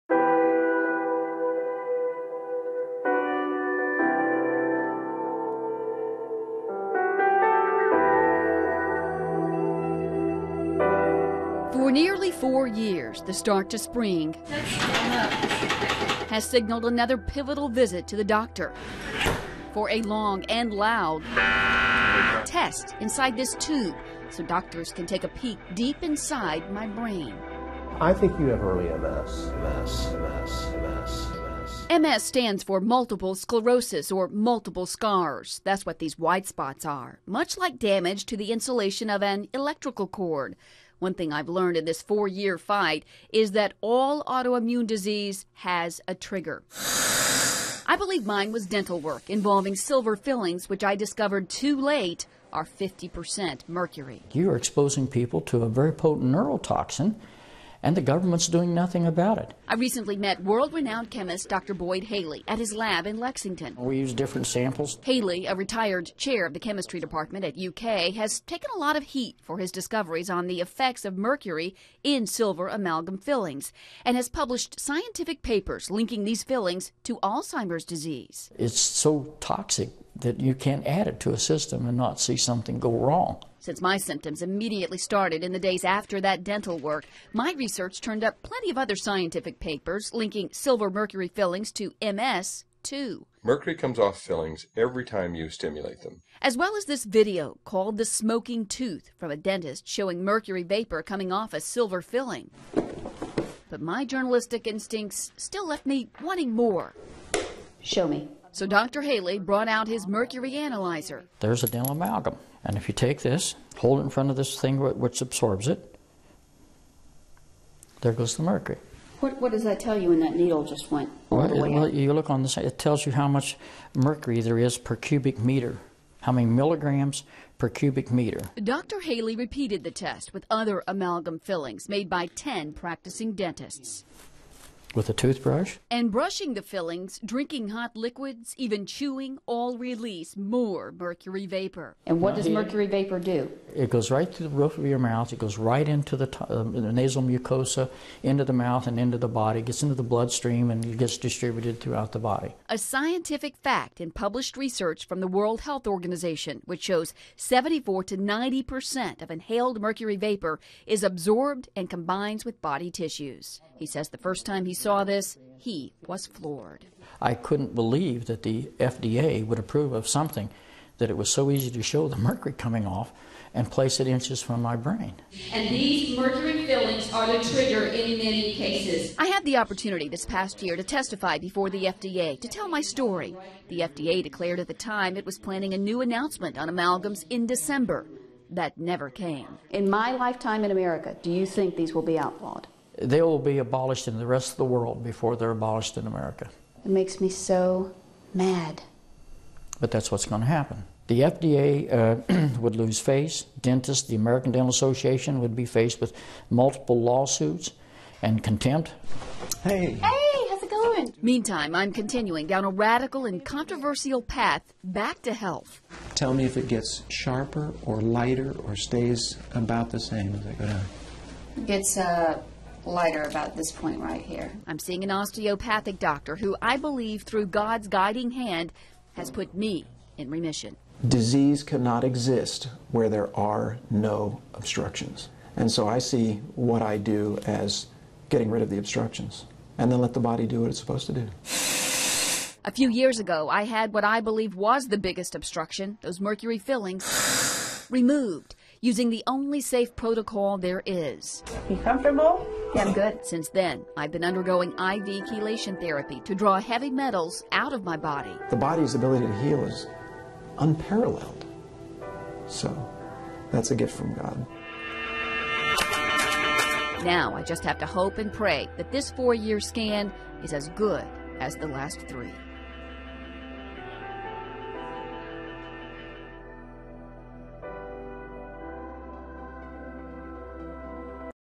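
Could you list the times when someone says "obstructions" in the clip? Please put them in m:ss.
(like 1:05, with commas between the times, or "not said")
3:54, 3:58, 4:05.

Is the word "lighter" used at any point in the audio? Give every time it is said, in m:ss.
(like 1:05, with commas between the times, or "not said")
3:37, 3:42.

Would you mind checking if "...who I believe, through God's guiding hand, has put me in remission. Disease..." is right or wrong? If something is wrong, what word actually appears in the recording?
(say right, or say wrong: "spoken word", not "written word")
right.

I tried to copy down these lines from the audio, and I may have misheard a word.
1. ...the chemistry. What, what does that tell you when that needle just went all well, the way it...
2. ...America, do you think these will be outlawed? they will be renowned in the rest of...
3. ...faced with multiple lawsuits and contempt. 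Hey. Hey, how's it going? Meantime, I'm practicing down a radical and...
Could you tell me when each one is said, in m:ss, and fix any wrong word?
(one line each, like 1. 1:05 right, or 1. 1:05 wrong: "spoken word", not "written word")
1. 1:58 wrong: "mercury", not "chemistry"
2. 3:10 wrong: "abolished", not "renowned"
3. 3:25 wrong: "continuing", not "practicing".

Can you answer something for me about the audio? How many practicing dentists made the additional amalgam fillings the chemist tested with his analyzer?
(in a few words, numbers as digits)
10.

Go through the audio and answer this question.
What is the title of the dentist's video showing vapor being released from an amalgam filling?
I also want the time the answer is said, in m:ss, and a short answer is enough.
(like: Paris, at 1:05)
The Smoking Tooth, at 1:37.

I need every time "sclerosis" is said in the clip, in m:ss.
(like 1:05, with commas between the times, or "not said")
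0:33.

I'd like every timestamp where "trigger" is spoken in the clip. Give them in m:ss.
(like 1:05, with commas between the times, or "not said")
0:46, 2:57.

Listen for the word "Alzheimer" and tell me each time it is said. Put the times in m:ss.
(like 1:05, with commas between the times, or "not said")
1:17.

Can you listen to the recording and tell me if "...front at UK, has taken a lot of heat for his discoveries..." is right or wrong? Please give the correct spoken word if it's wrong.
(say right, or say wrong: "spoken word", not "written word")
wrong: "department", not "front".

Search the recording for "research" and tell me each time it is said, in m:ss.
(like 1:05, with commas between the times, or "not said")
1:27, 2:34.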